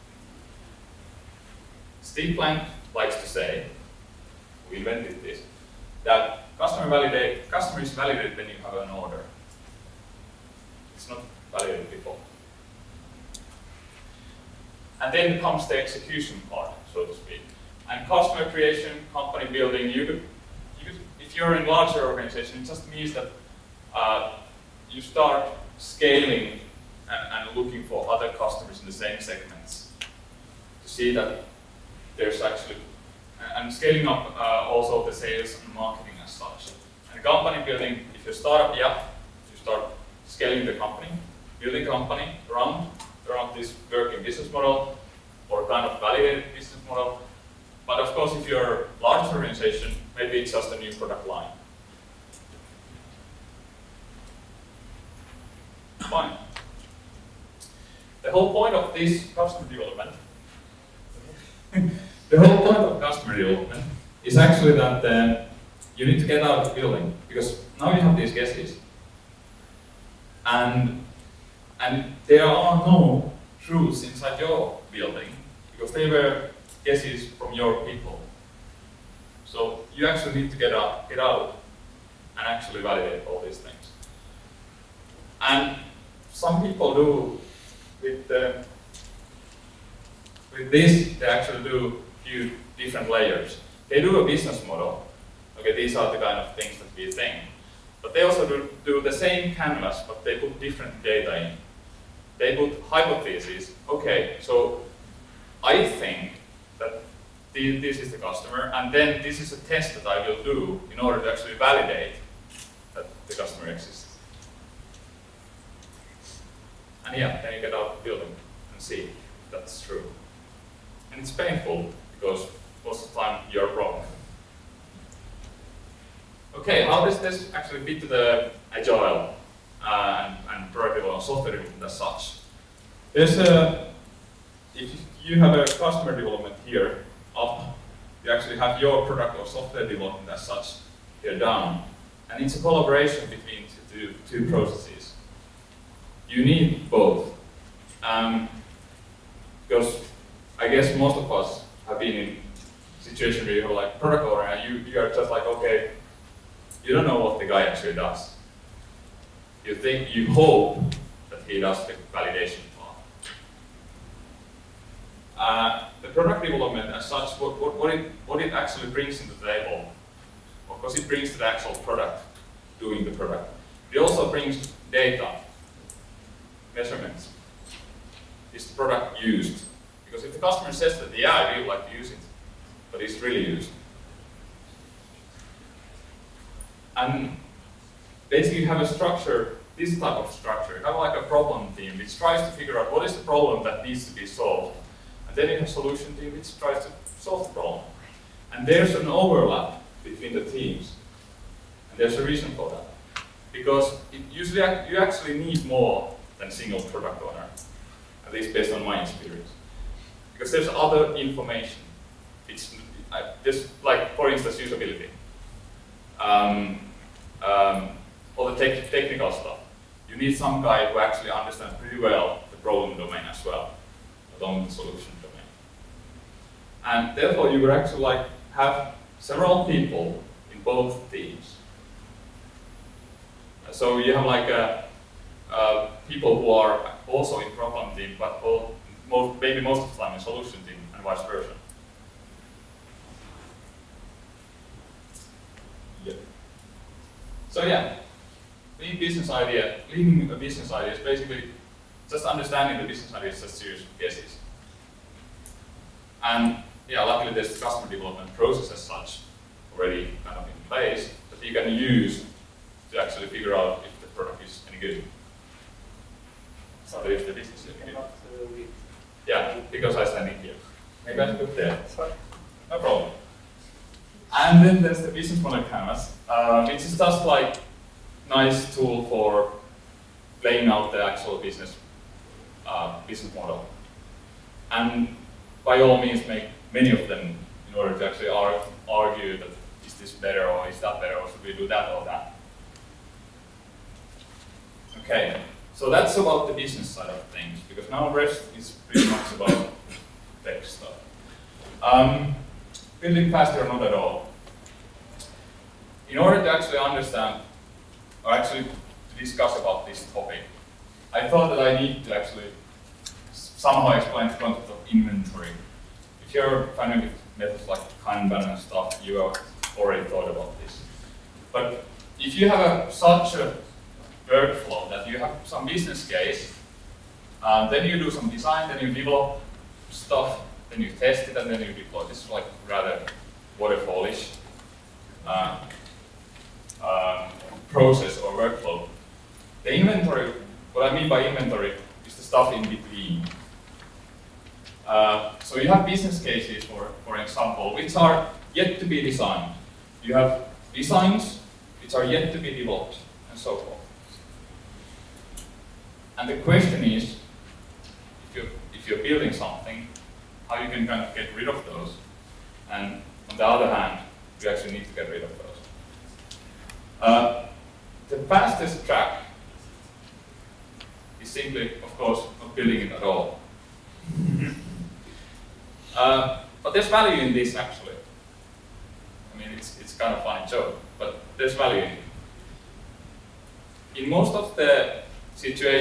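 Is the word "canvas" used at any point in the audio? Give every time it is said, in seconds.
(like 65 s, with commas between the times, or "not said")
99 s, 275 s.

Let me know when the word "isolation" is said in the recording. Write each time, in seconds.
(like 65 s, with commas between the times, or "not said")
not said.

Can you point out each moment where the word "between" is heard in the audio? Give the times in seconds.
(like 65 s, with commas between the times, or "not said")
143 s, 200 s, 342 s.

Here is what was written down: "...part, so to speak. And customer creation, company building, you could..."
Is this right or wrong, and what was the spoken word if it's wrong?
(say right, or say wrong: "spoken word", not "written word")
right.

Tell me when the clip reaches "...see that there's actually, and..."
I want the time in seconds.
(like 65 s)
30 s.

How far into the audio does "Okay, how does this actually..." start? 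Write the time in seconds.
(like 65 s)
126 s.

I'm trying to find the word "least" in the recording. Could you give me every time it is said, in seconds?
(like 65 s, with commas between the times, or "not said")
208 s.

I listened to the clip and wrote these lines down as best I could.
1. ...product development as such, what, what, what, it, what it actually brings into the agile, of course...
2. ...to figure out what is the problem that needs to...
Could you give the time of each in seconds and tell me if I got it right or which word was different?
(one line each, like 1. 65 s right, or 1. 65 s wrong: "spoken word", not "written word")
1. 166 s wrong: "table", not "agile"
2. 192 s right.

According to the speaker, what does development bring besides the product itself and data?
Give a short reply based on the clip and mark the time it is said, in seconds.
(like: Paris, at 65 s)
Measurements, at 176 s.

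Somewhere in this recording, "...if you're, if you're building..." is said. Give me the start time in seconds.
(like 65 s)
358 s.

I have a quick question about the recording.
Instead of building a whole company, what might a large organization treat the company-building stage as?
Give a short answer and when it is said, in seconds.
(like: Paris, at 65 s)
A new product line, at 50 s.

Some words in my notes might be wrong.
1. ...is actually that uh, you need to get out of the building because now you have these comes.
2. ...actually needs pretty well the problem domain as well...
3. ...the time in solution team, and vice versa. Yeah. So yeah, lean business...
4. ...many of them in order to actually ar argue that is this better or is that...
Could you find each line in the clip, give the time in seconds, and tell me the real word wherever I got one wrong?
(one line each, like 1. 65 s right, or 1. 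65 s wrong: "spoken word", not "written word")
1. 64 s wrong: "guesses", not "comes"
2. 220 s wrong: "understands", not "needs"
3. 239 s right
4. 286 s right.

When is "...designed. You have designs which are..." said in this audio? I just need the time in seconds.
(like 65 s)
348 s.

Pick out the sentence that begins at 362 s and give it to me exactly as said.
And on the other hand, you actually need to get rid of those.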